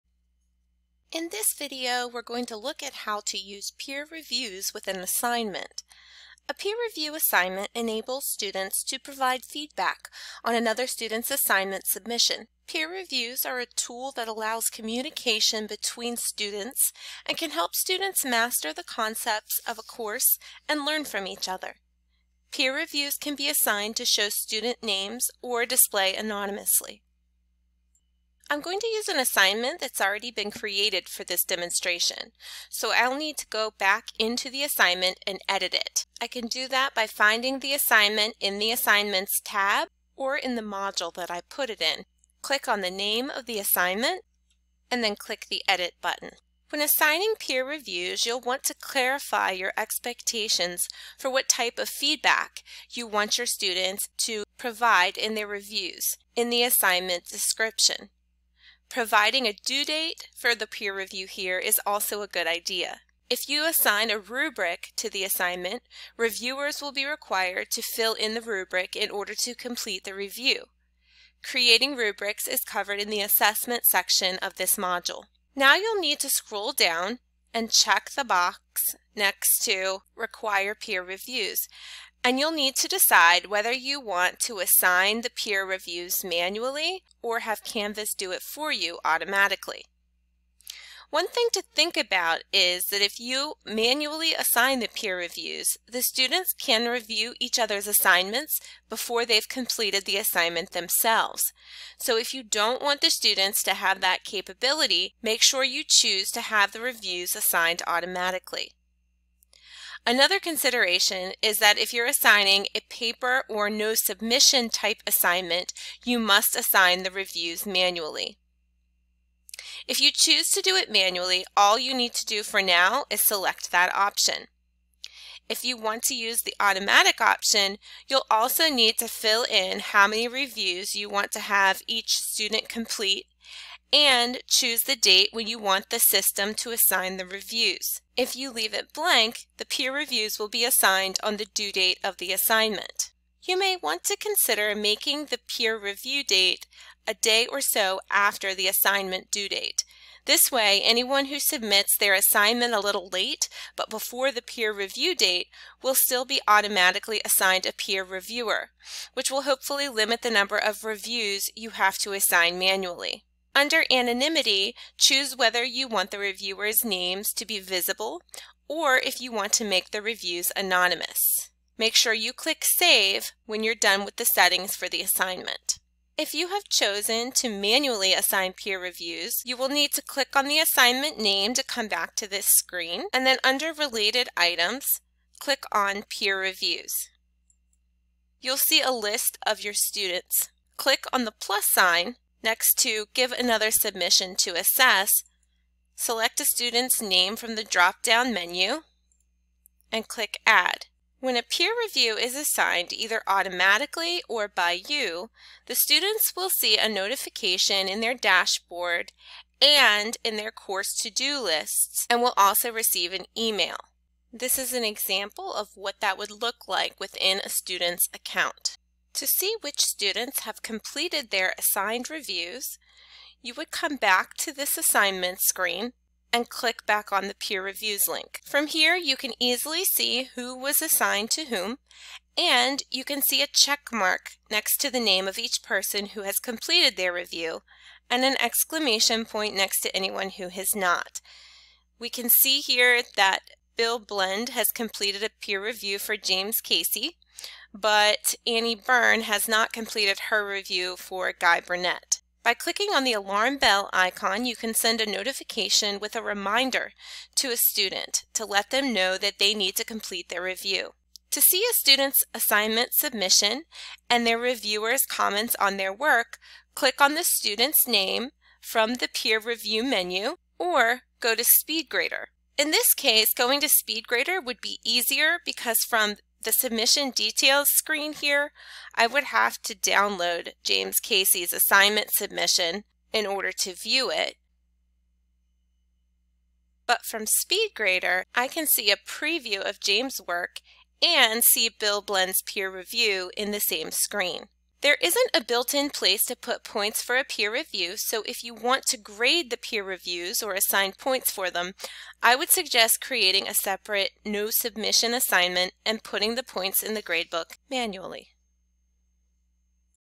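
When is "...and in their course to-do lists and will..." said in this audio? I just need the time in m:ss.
3:29.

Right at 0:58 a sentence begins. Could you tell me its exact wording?
Providing a due date for the peer review here is also a good idea.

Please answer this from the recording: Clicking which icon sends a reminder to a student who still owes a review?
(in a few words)
Alarm bell.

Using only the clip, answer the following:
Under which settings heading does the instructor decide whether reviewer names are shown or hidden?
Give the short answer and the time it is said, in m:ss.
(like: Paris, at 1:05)
Anonymity, at 2:43.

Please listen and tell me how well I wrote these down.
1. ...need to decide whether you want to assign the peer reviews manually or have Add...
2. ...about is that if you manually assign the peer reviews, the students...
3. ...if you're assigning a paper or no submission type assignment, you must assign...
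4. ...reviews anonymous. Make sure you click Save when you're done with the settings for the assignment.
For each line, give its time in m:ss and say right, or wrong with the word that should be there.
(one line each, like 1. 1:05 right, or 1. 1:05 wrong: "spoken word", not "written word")
1. 1:22 wrong: "Canvas", not "Add"
2. 1:31 right
3. 1:51 right
4. 2:50 right.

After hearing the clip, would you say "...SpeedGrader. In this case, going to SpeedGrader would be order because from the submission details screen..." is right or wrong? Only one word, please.
wrong.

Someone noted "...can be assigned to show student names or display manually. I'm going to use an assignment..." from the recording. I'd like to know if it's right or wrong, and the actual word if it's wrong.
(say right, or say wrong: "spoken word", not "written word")
wrong: "anonymously", not "manually".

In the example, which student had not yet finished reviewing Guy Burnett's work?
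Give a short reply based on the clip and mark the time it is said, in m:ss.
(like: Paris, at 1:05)
Annie Byrne, at 4:08.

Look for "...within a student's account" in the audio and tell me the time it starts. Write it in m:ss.
3:36.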